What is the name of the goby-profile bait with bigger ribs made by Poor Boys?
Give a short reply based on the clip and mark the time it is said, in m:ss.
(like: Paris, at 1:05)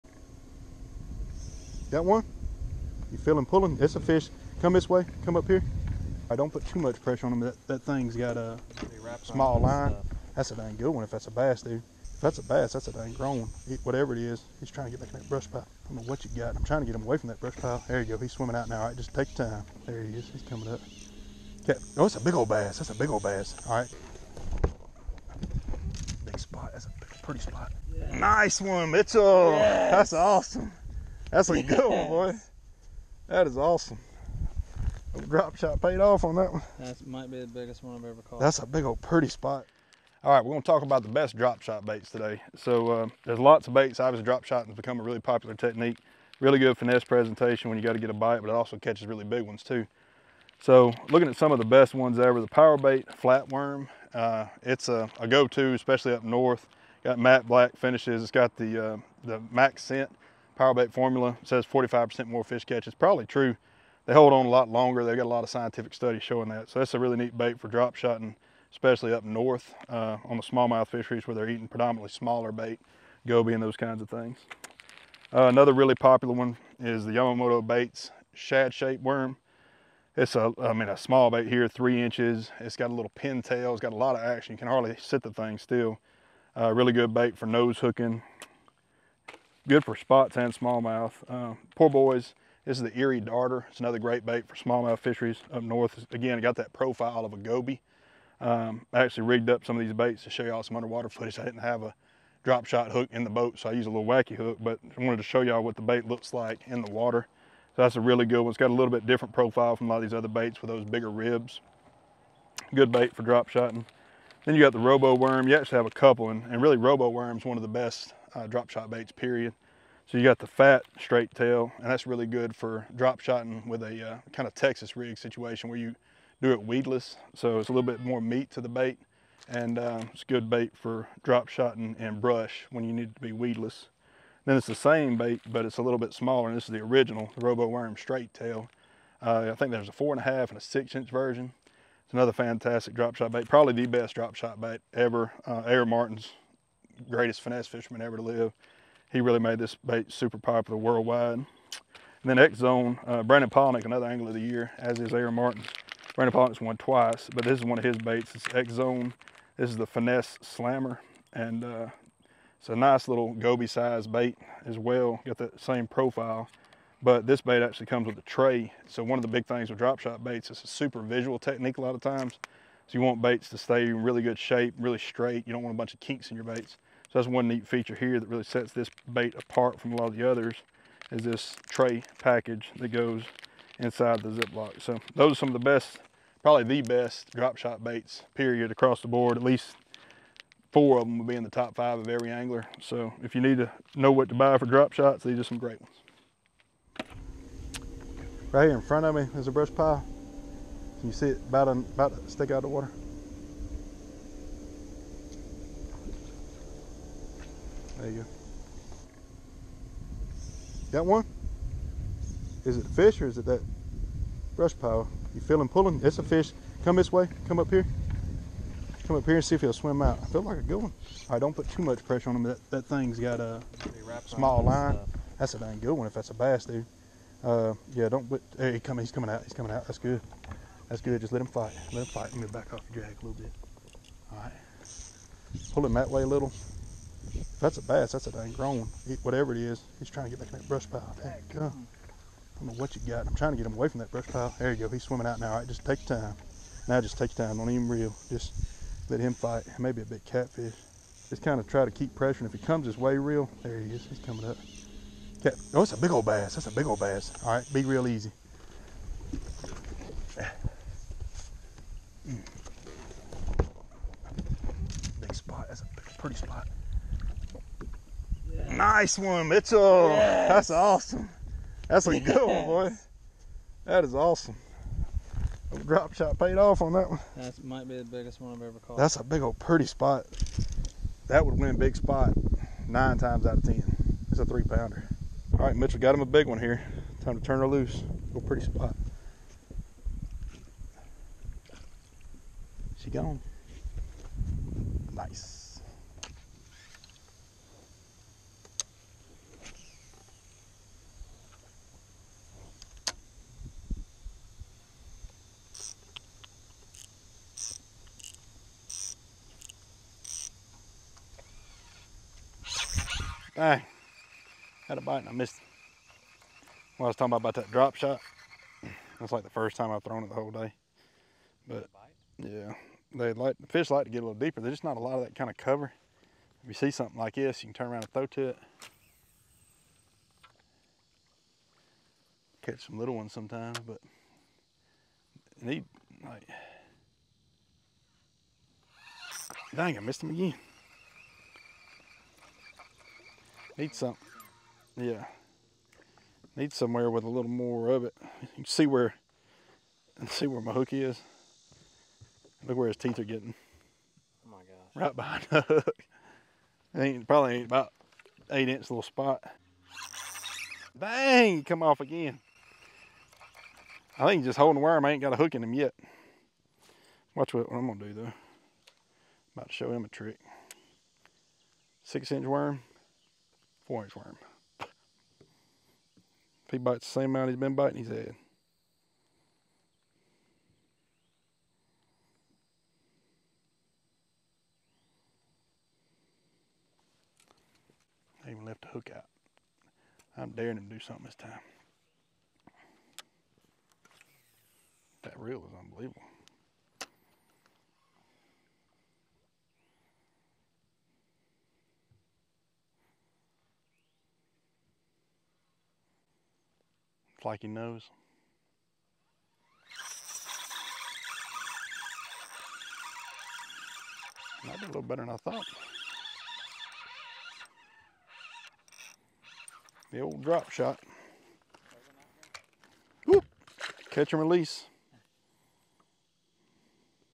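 Erie darter, at 1:32.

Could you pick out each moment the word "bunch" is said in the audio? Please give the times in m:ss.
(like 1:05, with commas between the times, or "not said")
2:55.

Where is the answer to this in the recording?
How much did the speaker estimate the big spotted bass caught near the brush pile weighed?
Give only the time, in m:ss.
4:44.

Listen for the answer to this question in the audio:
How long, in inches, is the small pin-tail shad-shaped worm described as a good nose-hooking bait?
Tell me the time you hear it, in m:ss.
1:21.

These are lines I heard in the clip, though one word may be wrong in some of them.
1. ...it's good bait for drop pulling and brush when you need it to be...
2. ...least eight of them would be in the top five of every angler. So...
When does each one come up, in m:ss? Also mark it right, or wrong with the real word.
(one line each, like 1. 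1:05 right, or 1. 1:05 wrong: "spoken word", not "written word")
1. 2:10 wrong: "shotting", not "pulling"
2. 3:09 wrong: "four", not "eight".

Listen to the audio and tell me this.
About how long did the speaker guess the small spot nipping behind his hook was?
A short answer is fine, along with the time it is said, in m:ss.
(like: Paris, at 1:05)
8 inches, at 5:58.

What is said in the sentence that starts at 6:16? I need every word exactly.
If he bites the same amount he's been biting, he's dead.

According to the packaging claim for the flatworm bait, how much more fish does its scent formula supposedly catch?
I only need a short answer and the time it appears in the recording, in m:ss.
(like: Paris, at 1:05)
45%, at 1:01.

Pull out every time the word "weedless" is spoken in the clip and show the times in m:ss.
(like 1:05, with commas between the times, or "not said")
2:06, 2:13.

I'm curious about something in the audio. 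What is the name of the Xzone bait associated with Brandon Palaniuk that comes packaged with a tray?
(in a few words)
finesse slammer.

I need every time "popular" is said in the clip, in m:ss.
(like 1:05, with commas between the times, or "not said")
0:45, 1:15, 2:30.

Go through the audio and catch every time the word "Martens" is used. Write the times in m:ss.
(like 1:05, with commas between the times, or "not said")
2:25, 2:35.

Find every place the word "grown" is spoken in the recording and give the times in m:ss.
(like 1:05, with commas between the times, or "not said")
0:13, 3:58.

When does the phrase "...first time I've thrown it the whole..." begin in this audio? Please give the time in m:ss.
5:19.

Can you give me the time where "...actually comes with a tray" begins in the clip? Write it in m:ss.
2:47.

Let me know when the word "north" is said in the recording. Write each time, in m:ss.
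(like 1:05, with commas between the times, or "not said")
0:56, 1:09, 1:35.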